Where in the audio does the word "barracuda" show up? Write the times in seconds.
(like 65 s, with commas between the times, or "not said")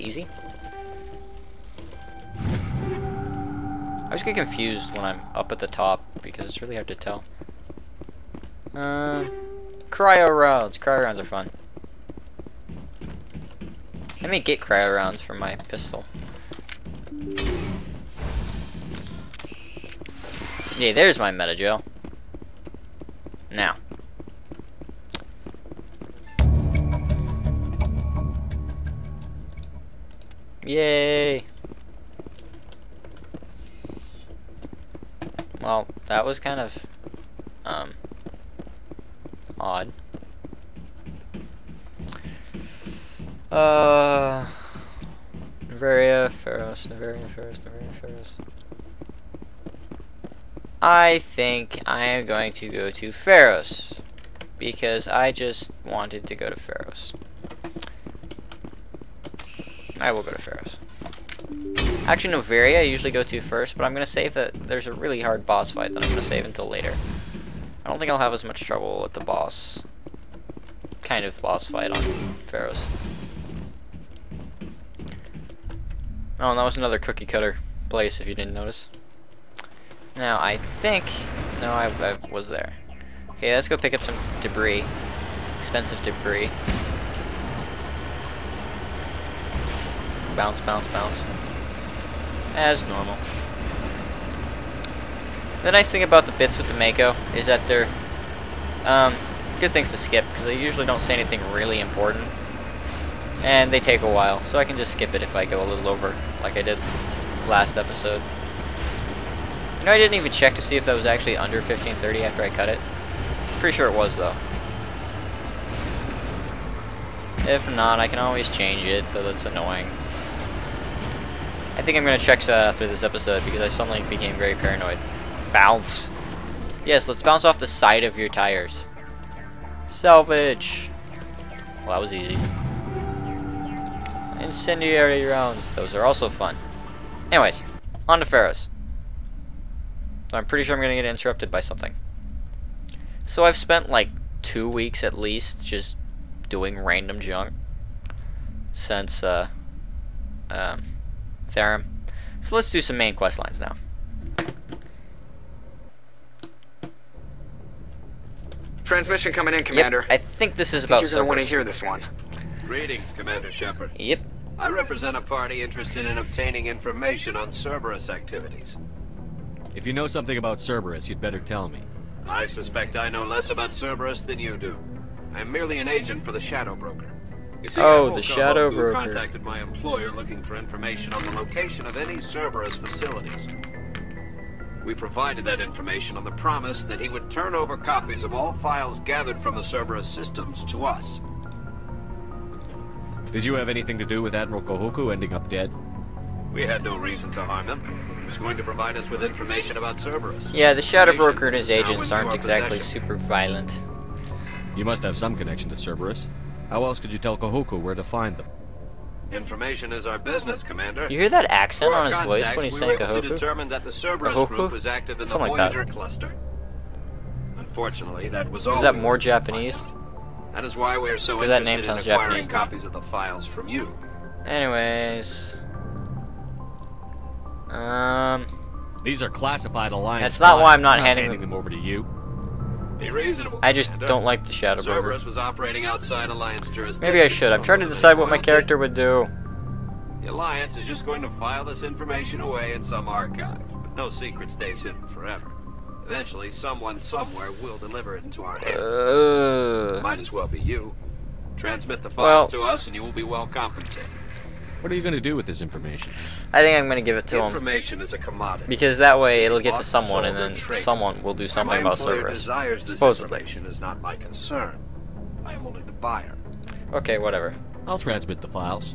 not said.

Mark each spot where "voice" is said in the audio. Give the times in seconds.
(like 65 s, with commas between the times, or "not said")
212 s.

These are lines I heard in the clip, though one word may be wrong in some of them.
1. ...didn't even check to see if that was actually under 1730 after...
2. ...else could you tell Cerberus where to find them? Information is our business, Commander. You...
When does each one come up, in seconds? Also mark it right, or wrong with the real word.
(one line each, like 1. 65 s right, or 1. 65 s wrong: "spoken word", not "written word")
1. 109 s wrong: "1530", not "1730"
2. 206 s wrong: "Kahoku", not "Cerberus".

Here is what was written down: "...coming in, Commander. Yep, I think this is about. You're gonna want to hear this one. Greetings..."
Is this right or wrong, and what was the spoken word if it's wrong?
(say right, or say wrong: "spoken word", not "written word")
right.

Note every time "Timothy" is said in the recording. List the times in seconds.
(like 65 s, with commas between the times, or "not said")
not said.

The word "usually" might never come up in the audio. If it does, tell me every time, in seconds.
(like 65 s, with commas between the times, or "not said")
62 s, 100 s.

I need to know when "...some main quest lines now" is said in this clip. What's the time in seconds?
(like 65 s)
152 s.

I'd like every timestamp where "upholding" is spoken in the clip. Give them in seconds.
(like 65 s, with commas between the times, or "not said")
not said.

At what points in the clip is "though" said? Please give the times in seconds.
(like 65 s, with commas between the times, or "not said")
114 s, 119 s.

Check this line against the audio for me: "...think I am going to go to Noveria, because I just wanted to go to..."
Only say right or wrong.
wrong.